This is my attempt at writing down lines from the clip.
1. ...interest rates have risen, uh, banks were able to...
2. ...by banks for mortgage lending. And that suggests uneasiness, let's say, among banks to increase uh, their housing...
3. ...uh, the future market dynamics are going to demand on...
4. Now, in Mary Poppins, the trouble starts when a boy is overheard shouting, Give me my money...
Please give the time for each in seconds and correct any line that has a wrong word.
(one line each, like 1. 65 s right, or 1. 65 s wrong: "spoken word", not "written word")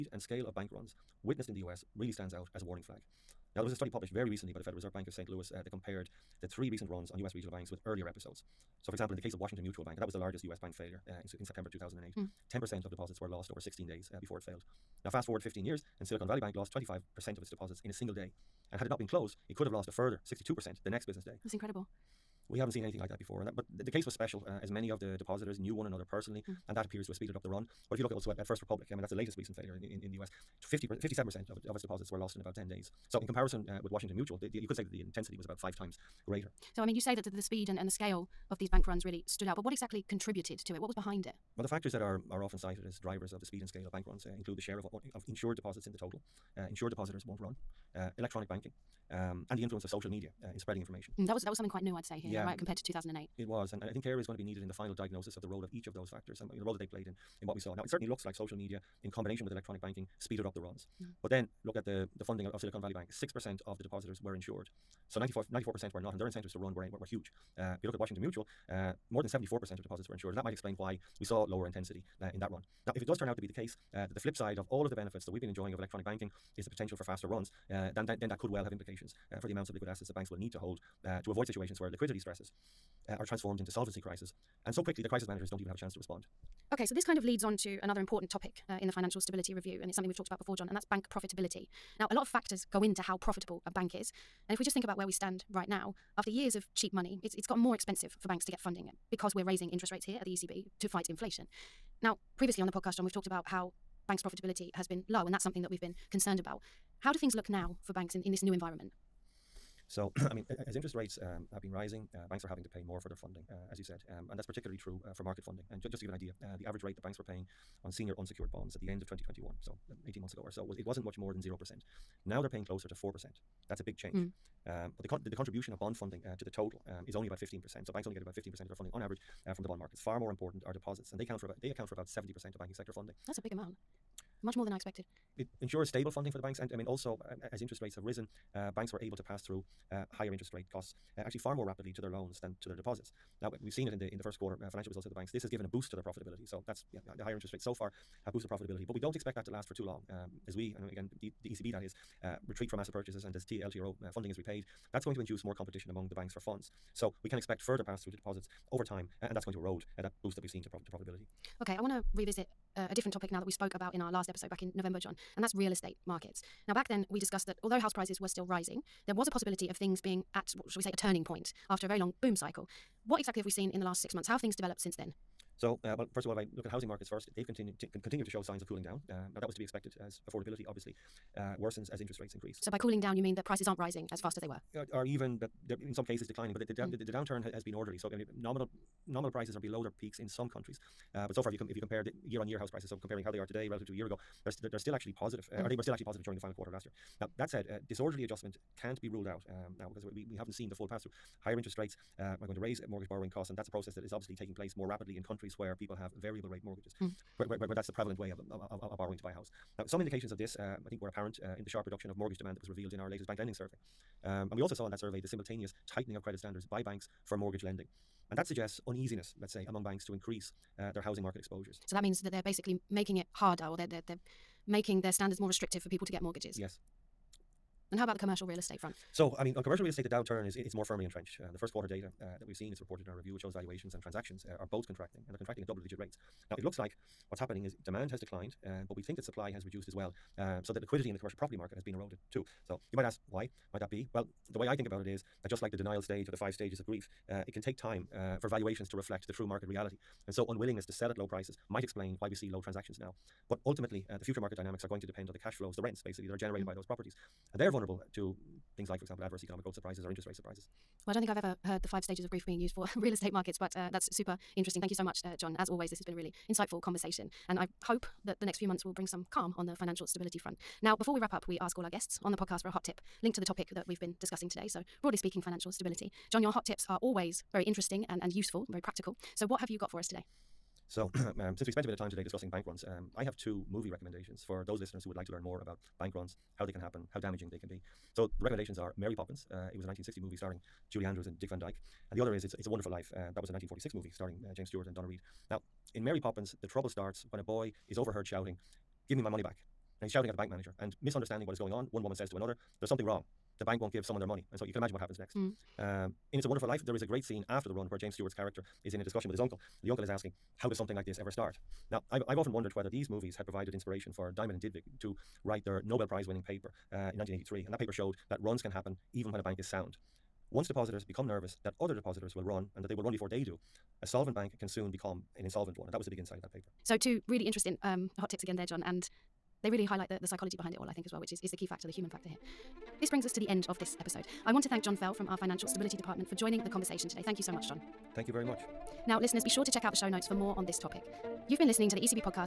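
1. 137 s right
2. 216 s right
3. 254 s wrong: "depend", not "demand"
4. 295 s right.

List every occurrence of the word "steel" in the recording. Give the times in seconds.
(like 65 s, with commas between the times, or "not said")
not said.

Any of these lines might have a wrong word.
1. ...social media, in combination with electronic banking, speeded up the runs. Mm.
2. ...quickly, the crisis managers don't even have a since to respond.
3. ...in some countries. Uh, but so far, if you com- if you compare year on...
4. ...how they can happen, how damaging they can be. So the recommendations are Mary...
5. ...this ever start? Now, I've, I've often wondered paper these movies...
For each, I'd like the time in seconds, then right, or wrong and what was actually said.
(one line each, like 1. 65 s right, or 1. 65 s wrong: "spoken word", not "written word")
1. 58 s right
2. 84 s wrong: "chance", not "since"
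3. 190 s right
4. 286 s right
5. 311 s wrong: "whether", not "paper".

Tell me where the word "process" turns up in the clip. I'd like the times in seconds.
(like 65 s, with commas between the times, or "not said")
203 s.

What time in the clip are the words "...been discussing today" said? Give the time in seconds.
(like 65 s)
274 s.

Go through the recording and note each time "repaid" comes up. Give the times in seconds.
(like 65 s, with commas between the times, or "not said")
154 s.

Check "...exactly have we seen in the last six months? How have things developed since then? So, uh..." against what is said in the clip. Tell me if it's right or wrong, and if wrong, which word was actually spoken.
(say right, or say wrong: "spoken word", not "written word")
right.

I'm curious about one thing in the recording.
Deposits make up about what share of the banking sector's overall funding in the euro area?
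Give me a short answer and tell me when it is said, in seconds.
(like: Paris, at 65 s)
70%, at 132 s.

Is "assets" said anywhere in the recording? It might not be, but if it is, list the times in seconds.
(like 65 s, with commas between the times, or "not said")
79 s, 152 s.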